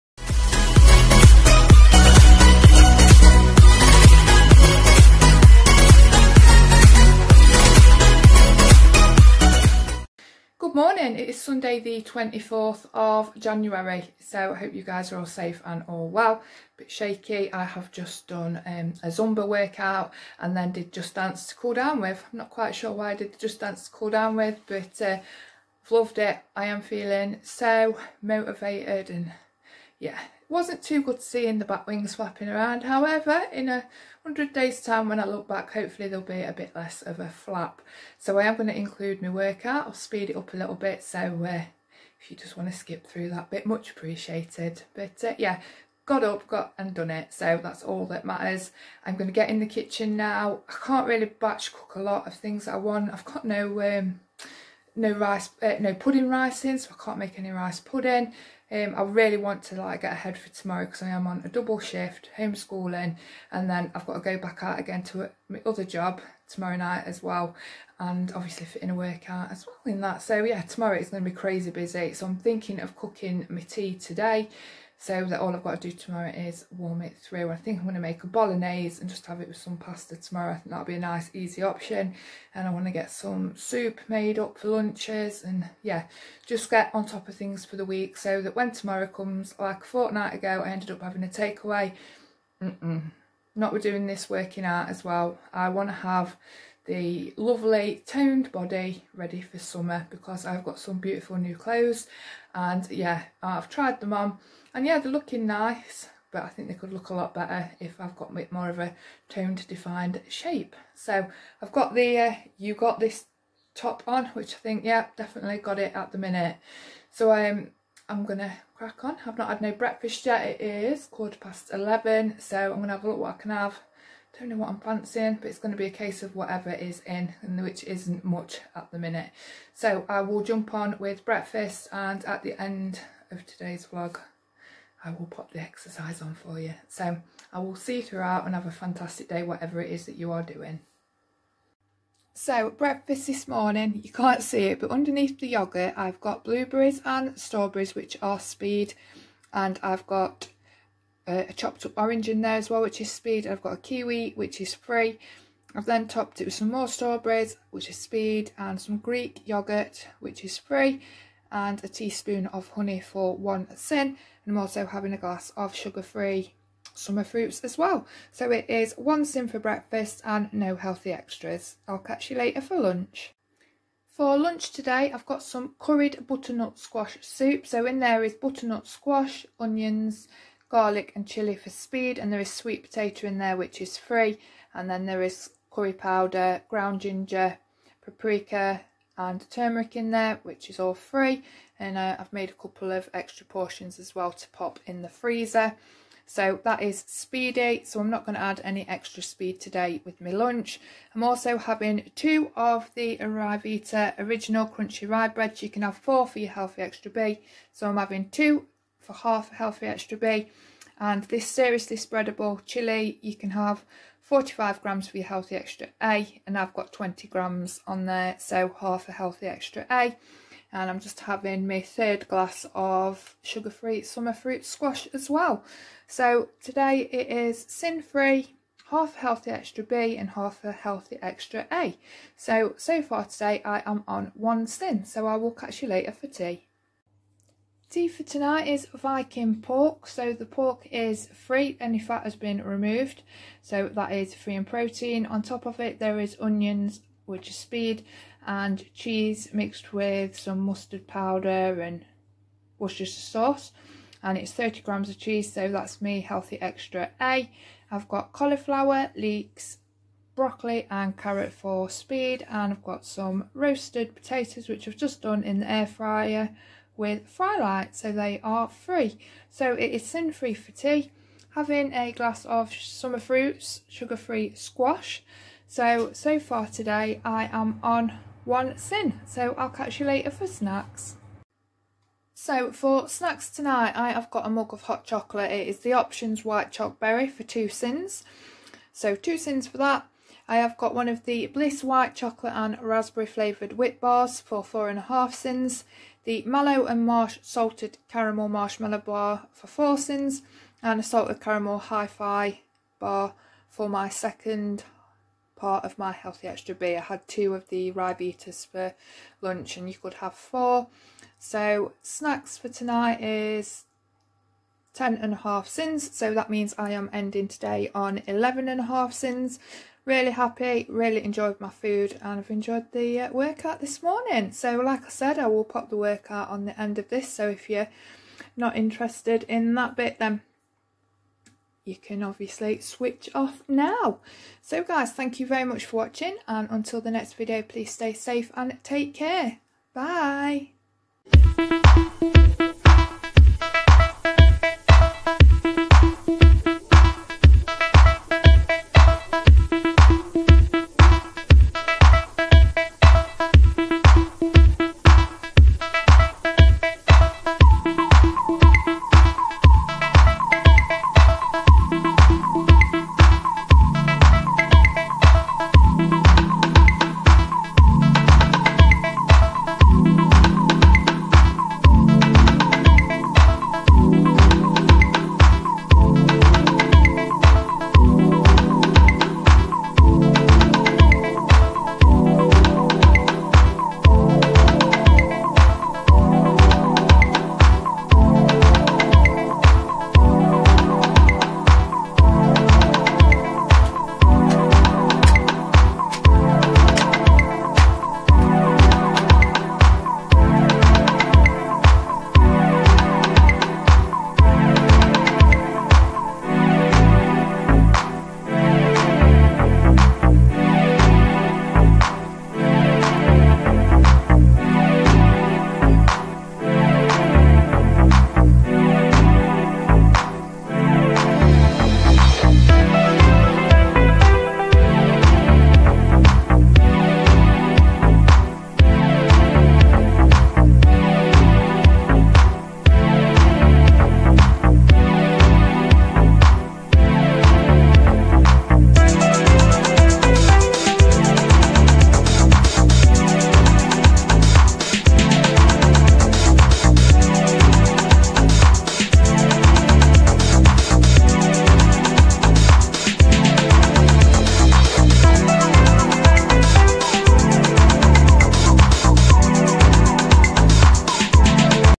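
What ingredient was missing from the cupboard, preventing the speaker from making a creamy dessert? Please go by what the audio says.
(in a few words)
pudding rice.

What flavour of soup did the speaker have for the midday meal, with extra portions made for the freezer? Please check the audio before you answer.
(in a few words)
curried butternut squash.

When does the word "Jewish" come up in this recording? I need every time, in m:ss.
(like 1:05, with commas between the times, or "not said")
not said.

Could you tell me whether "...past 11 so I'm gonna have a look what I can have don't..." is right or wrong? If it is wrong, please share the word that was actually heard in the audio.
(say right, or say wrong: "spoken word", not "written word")
right.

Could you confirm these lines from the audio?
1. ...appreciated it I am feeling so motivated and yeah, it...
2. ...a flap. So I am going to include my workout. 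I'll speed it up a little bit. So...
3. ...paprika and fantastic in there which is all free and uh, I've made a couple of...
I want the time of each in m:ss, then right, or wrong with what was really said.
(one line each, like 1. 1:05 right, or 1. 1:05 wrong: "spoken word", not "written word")
1. 0:25 wrong: "loved", not "appreciated"
2. 0:37 right
3. 3:08 wrong: "turmeric", not "fantastic".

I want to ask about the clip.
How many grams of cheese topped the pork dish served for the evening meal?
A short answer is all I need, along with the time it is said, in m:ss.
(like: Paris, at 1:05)
30 grams, at 4:14.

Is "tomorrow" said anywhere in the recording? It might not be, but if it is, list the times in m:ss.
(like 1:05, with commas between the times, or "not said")
1:00, 1:06, 1:10, 1:15, 1:20, 1:28.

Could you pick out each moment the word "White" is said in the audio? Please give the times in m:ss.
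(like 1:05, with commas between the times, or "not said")
4:46, 4:51.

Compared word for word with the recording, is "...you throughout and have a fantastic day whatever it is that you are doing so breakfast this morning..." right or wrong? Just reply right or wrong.
right.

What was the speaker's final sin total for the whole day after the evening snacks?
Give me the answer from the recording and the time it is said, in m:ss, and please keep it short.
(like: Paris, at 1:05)
11 and a half, at 5:18.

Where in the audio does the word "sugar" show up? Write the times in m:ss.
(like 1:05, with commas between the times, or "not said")
2:45, 3:43, 4:33.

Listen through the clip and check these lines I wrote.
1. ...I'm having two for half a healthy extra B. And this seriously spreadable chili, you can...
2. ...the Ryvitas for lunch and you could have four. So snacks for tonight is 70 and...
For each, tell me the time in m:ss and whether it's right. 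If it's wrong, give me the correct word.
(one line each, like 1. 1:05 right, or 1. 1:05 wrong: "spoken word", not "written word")
1. 3:27 right
2. 5:07 wrong: "10", not "70".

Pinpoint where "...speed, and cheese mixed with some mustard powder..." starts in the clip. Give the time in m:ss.
4:07.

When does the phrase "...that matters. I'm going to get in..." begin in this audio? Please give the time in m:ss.
0:48.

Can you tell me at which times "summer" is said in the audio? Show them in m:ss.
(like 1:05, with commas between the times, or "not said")
1:39, 2:46, 3:44, 4:32.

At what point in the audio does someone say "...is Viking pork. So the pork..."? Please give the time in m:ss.
3:58.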